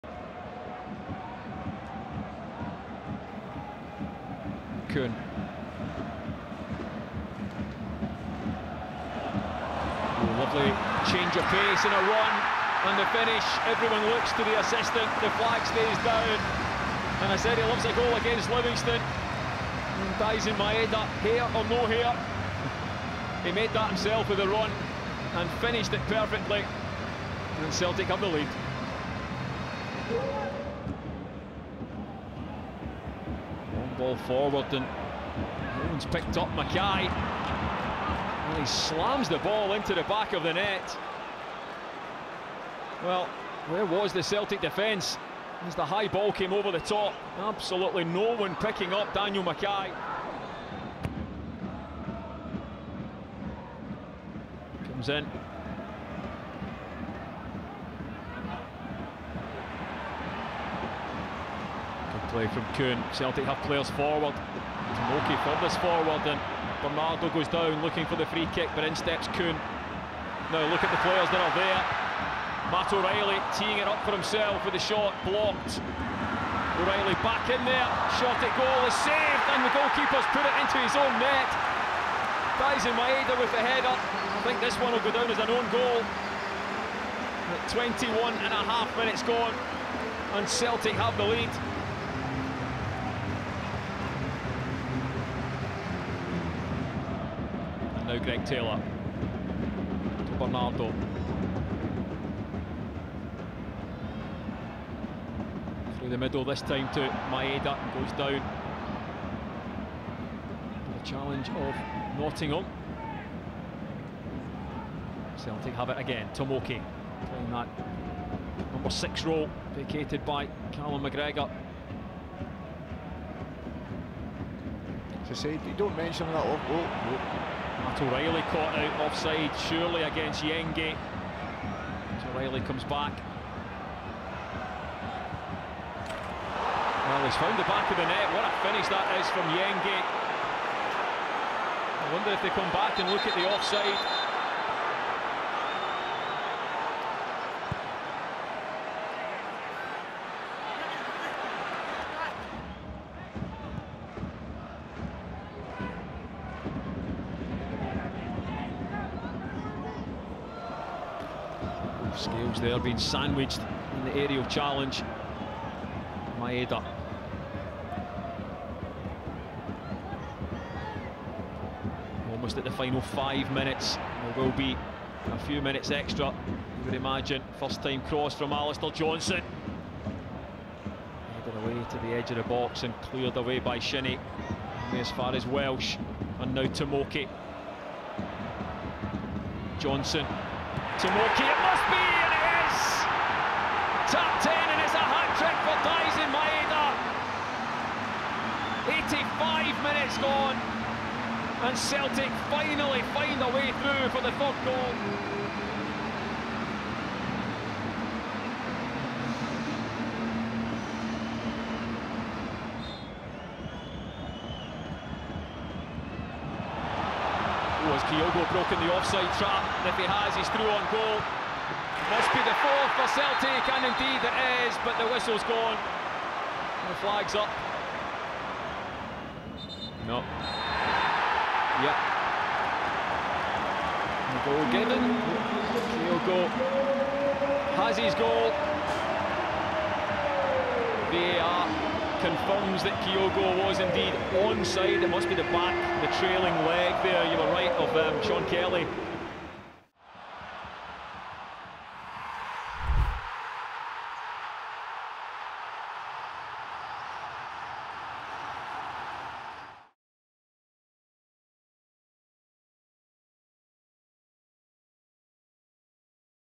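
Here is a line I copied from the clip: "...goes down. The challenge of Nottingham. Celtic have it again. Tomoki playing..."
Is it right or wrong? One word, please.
right.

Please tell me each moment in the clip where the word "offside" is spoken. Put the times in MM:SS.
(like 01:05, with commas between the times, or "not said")
02:09, 02:23, 03:38.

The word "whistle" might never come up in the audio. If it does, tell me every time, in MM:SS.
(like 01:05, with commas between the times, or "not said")
03:45.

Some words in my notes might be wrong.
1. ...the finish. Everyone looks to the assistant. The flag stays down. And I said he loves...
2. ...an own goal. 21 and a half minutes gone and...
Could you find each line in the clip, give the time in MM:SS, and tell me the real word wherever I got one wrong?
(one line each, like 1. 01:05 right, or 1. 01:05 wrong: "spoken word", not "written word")
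1. 00:12 right
2. 01:25 right.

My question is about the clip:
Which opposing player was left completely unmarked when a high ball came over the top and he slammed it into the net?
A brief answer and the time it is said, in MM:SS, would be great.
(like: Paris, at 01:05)
Daniel MacKay, at 00:49.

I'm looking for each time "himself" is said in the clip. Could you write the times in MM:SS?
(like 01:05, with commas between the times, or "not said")
00:23, 01:14.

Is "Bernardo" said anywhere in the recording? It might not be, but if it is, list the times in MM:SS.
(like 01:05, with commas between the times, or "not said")
01:06, 01:40.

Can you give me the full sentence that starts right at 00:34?
ball forward and no one's picked up MacKay.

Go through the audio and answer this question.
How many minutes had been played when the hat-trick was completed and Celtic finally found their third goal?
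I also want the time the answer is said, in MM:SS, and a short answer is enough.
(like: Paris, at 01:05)
85, at 03:19.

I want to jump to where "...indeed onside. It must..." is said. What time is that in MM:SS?
04:03.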